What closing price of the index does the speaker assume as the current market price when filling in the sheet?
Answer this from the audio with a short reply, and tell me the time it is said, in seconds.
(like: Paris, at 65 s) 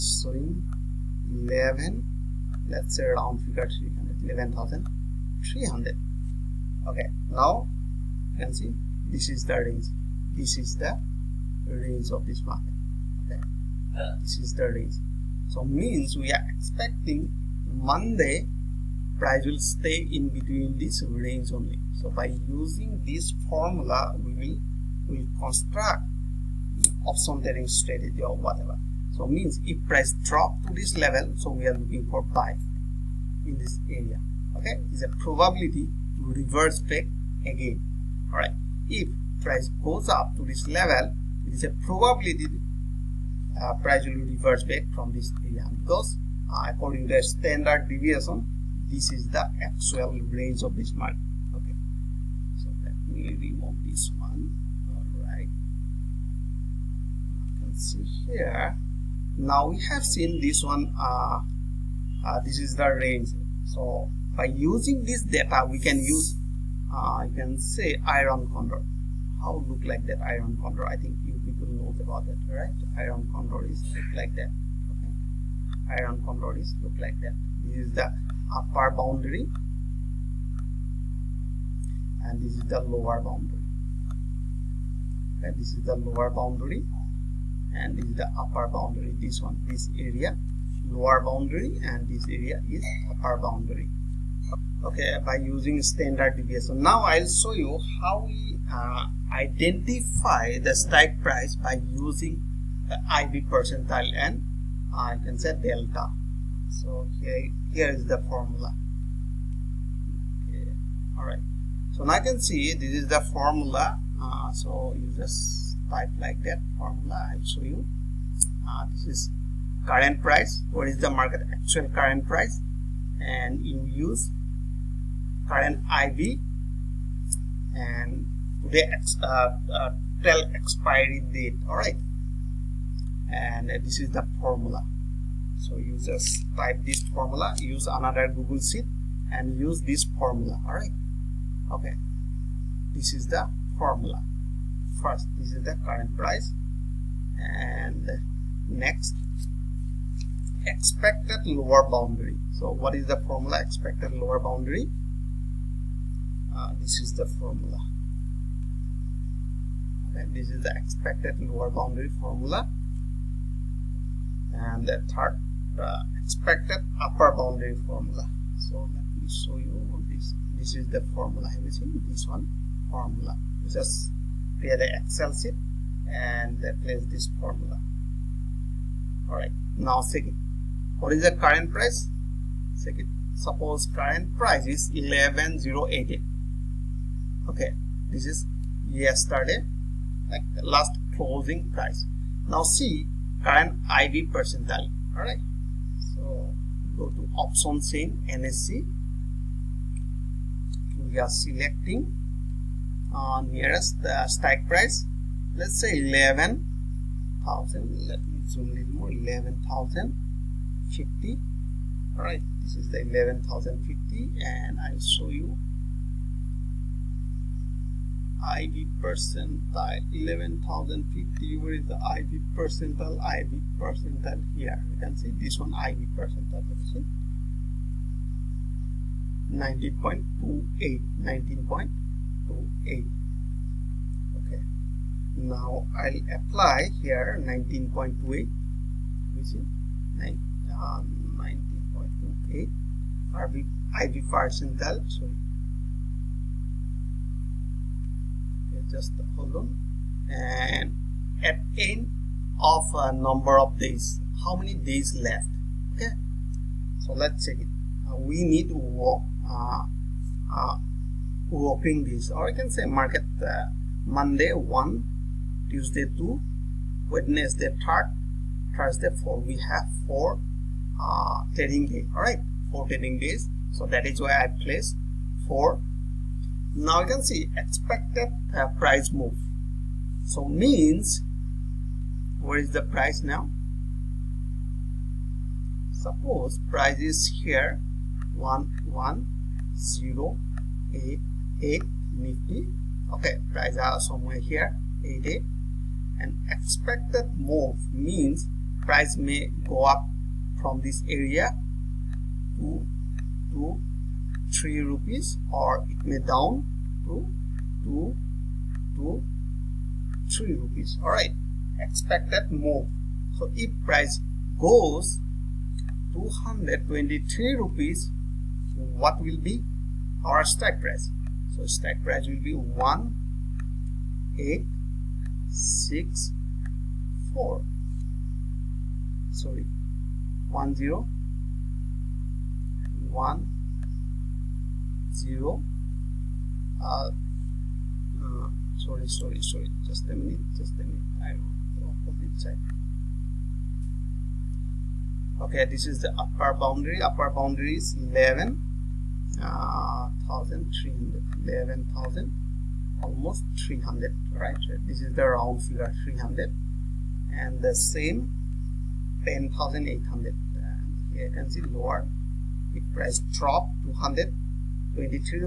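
11080, at 184 s.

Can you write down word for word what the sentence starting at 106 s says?
So here, here is the formula.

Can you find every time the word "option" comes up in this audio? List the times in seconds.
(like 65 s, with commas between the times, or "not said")
27 s, 197 s.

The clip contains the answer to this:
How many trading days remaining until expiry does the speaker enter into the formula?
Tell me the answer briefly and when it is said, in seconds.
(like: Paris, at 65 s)
4, at 272 s.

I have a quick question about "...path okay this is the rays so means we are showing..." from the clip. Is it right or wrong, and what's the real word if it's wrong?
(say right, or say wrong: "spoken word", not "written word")
wrong: "expecting", not "showing".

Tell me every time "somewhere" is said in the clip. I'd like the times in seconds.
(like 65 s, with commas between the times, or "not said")
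293 s.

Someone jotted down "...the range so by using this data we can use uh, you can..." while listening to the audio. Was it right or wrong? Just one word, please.
right.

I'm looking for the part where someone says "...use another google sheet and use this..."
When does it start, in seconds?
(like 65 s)
137 s.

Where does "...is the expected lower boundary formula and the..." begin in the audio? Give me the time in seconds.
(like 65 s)
160 s.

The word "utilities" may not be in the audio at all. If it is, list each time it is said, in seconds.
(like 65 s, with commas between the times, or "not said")
not said.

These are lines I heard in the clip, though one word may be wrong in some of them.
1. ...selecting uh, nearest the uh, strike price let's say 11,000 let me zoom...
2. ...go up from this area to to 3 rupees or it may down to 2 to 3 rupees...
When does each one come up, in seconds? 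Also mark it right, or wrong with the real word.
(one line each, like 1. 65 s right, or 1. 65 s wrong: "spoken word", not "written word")
1. 201 s right
2. 299 s right.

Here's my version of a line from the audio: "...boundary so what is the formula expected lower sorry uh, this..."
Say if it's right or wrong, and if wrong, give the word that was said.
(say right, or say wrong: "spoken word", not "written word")
wrong: "boundary", not "sorry".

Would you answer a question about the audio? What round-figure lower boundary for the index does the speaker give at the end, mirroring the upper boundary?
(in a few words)
10,800.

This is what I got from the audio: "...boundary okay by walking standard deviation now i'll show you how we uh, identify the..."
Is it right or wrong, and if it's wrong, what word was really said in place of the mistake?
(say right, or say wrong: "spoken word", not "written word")
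wrong: "using", not "walking".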